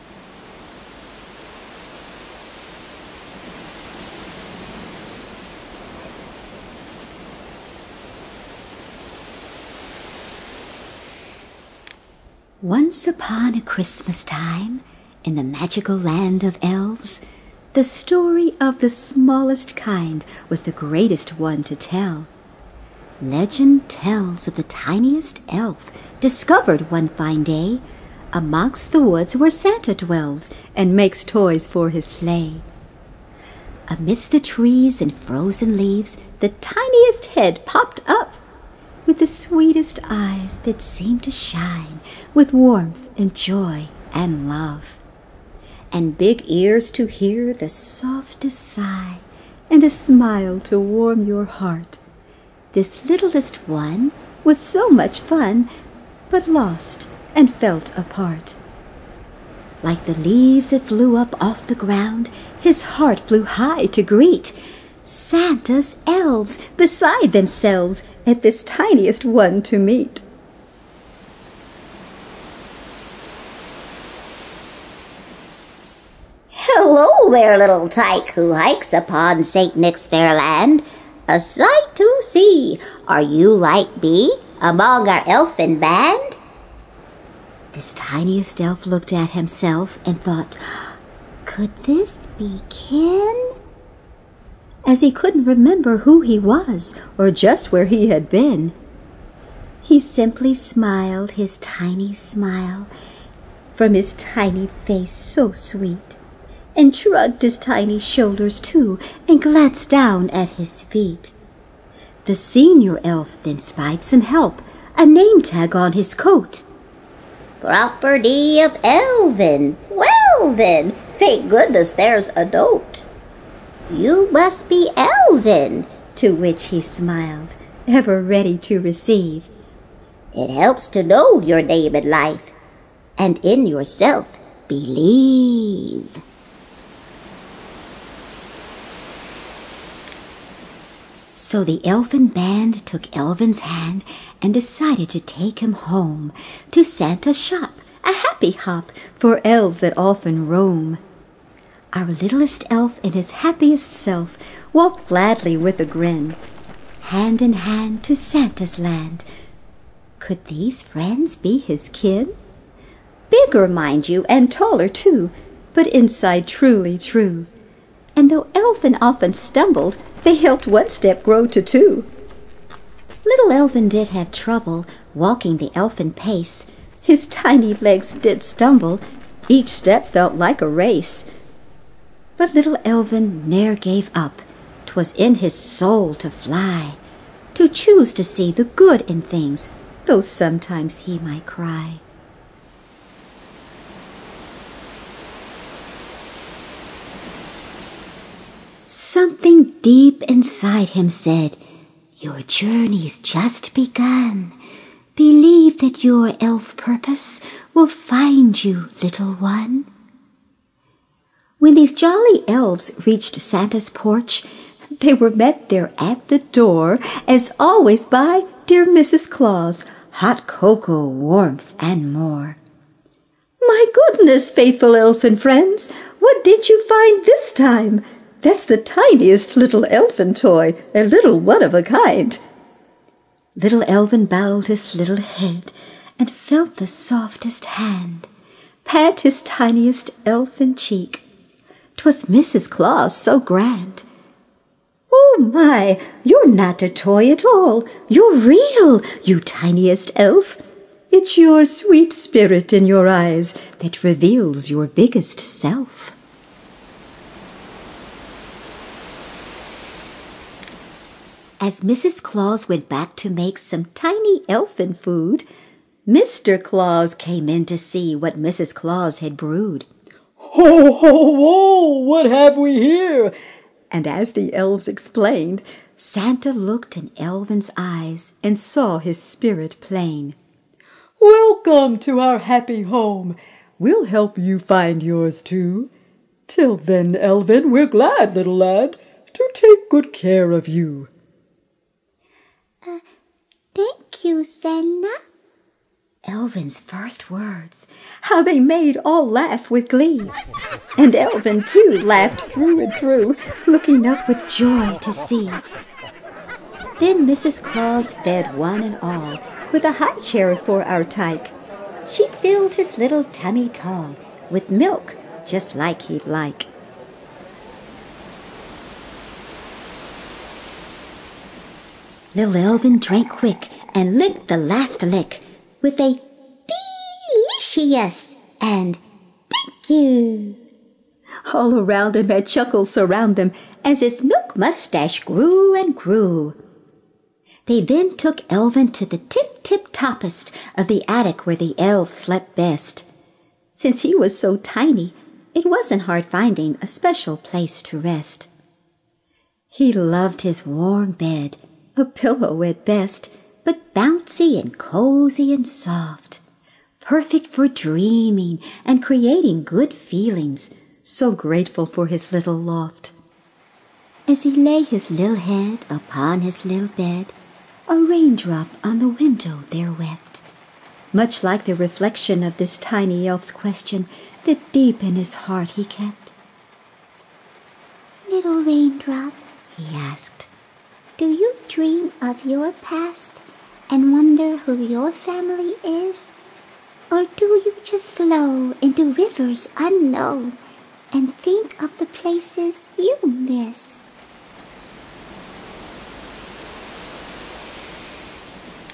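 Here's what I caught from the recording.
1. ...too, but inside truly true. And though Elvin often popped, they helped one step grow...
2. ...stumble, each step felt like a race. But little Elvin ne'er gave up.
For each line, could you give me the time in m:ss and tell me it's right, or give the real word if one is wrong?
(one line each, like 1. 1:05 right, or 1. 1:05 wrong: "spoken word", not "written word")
1. 2:44 wrong: "stumbled", not "popped"
2. 2:58 right.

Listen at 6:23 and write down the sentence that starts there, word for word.
and wonder who your family is?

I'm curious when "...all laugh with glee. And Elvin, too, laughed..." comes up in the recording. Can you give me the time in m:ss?
4:59.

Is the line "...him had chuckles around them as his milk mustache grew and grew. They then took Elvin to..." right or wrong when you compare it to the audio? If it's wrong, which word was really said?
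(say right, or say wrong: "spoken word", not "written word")
right.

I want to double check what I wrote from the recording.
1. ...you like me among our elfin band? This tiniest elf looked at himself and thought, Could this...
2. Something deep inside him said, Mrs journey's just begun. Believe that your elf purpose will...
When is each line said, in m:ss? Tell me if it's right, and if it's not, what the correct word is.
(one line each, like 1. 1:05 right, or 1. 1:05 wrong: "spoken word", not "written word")
1. 1:23 right
2. 3:18 wrong: "Your", not "Mrs".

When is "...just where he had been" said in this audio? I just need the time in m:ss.
1:37.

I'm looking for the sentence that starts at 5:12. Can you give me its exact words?
She filled his little tummy tall with milk, just like he'd like.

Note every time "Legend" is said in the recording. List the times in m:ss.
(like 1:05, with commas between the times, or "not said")
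0:23.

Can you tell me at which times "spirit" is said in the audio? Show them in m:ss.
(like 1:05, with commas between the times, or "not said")
4:12, 4:39.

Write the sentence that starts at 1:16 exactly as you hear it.
Hello there, little tyke who hikes upon St.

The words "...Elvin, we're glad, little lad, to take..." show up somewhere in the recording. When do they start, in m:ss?
4:47.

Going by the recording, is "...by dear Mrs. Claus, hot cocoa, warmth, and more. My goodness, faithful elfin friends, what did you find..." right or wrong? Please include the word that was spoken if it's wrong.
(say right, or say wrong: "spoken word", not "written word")
right.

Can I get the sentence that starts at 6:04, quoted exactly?
As he lay his little head upon his little bed, a raindrop on the window there wept.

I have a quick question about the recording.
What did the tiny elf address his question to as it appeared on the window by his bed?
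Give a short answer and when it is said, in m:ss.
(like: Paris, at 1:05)
a raindrop, at 6:18.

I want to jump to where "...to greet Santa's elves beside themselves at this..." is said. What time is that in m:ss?
1:03.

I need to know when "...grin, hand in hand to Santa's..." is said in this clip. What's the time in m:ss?
2:35.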